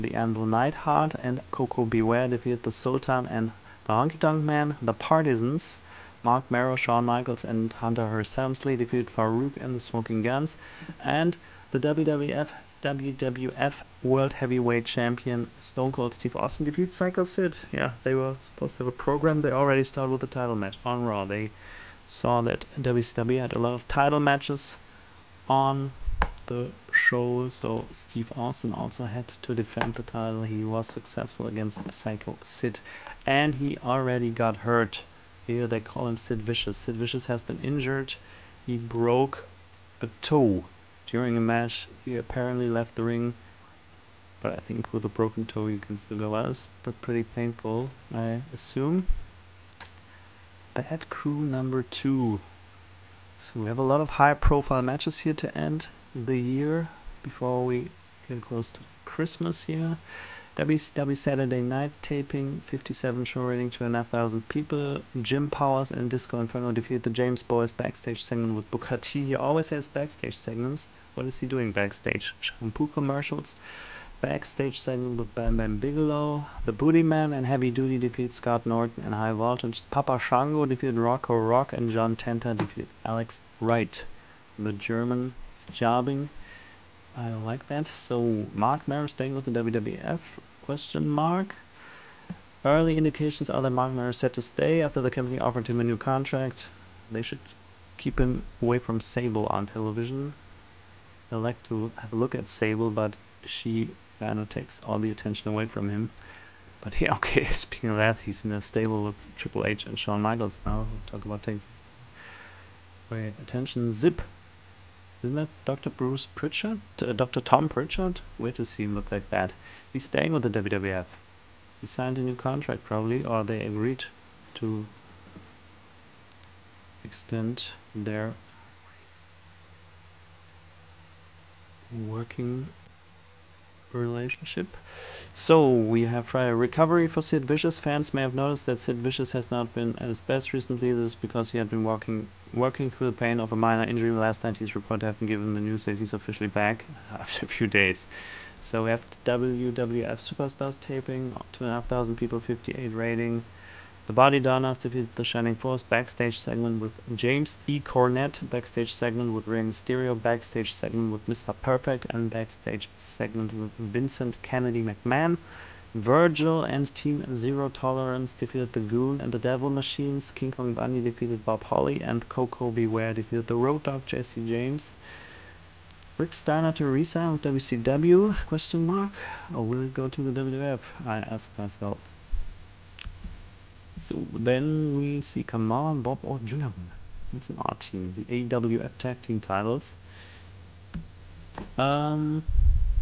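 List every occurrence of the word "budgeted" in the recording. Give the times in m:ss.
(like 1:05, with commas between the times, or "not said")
not said.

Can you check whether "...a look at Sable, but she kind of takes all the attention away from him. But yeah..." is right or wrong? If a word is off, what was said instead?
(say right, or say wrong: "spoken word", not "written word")
right.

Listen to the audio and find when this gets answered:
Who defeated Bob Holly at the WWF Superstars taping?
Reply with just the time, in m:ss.
2:50.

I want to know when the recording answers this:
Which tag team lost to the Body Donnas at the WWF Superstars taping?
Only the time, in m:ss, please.
2:35.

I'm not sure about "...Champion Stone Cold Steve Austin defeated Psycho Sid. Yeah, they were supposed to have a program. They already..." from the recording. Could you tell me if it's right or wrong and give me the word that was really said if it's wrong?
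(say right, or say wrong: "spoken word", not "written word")
right.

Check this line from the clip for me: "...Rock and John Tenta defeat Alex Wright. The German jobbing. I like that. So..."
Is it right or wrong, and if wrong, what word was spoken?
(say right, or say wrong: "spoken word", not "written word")
right.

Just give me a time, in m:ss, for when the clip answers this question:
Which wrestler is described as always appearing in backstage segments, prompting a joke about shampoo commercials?
1:08.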